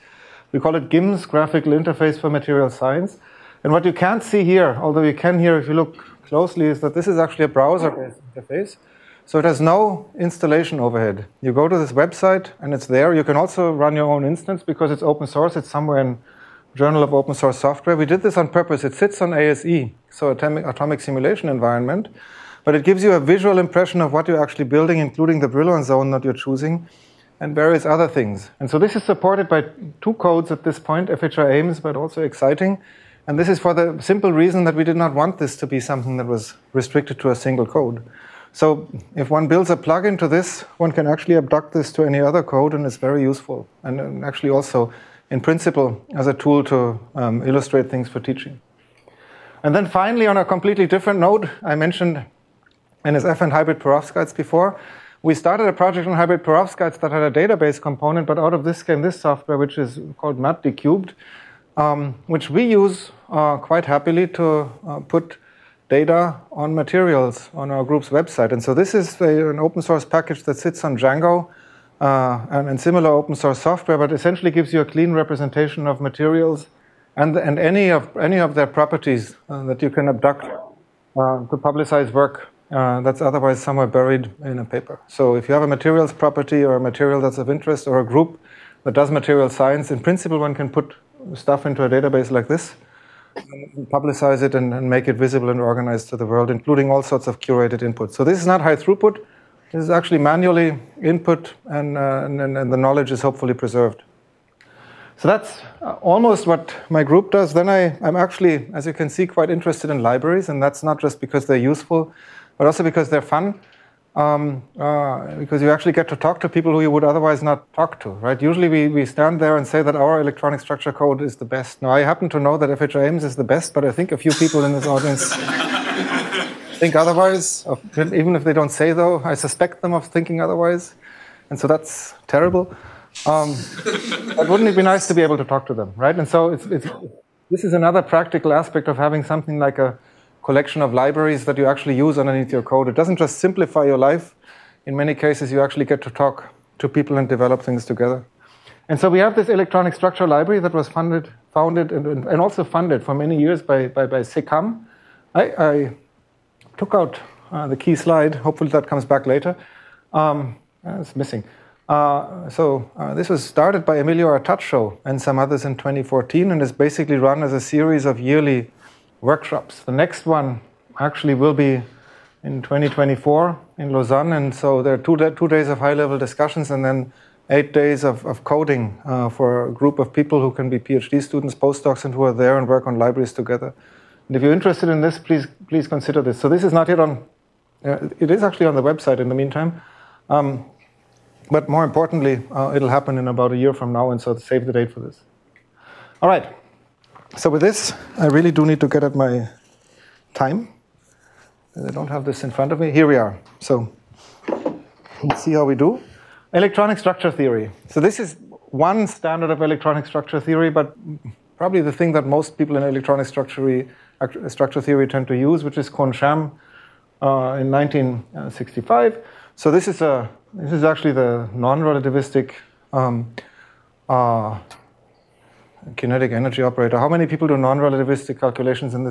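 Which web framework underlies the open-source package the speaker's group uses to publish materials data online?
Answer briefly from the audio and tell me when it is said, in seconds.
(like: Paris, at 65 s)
Django, at 70 s.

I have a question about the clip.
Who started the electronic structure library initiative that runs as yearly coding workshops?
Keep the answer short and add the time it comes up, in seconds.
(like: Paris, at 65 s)
Emilio Artacho, at 163 s.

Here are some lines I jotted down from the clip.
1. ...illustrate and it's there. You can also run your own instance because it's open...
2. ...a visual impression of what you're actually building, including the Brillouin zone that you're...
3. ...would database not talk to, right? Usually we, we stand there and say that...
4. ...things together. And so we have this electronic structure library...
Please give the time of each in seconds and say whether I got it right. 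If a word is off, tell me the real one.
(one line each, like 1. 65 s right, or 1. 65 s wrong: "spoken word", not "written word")
1. 11 s wrong: "website", not "illustrate"
2. 23 s right
3. 116 s wrong: "otherwise", not "database"
4. 147 s right.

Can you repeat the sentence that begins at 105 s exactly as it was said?
So that's uh, almost what my group does.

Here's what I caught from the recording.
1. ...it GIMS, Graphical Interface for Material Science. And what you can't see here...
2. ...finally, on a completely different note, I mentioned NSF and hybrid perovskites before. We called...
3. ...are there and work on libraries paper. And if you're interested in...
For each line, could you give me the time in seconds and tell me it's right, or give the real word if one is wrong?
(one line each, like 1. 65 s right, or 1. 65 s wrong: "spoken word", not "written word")
1. 0 s right
2. 49 s wrong: "started", not "called"
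3. 182 s wrong: "together", not "paper".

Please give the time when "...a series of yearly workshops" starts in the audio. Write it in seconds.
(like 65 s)
167 s.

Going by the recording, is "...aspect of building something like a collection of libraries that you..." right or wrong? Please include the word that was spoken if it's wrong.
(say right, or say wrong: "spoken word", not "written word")
wrong: "having", not "building".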